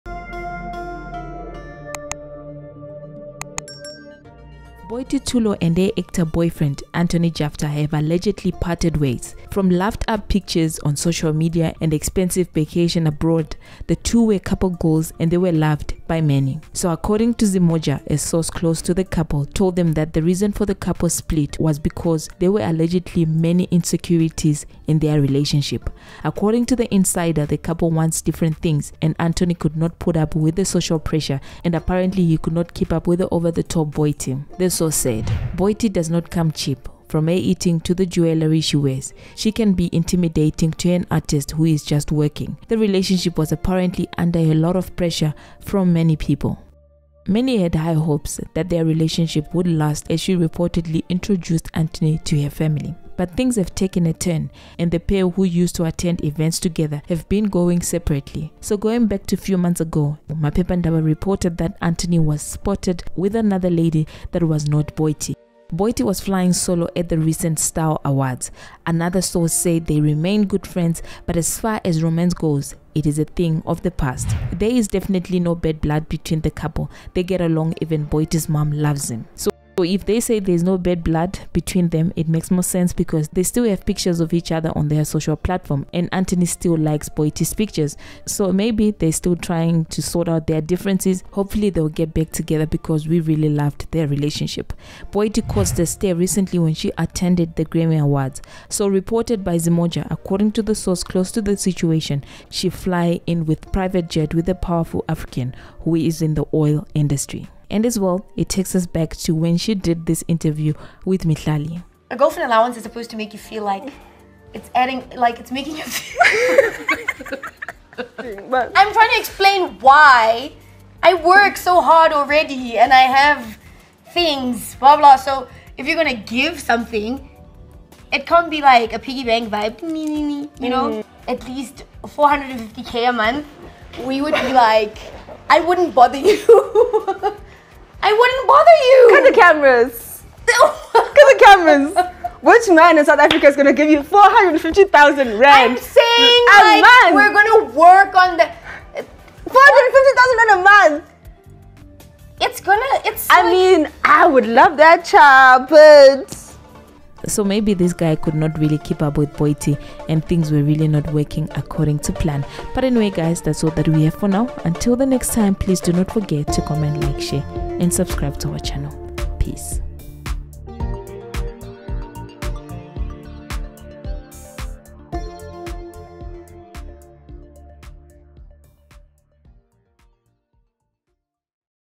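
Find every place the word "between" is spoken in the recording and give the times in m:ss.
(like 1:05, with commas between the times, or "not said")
1:16, 1:21.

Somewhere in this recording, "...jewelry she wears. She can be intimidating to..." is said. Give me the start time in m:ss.
0:38.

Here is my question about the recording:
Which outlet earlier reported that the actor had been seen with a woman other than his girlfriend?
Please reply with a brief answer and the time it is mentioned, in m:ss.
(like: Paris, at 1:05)
Maphepha Ndaba, at 1:00.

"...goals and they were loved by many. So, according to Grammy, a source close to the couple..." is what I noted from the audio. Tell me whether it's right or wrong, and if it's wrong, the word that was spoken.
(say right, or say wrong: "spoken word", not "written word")
wrong: "Zimoja", not "Grammy".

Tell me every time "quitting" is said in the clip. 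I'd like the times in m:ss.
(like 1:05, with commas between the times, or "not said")
not said.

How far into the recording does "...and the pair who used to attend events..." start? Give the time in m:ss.
0:54.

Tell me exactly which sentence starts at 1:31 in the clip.
Hopefully they'll get back together because we really loved their relationship.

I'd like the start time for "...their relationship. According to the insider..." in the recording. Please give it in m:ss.
0:24.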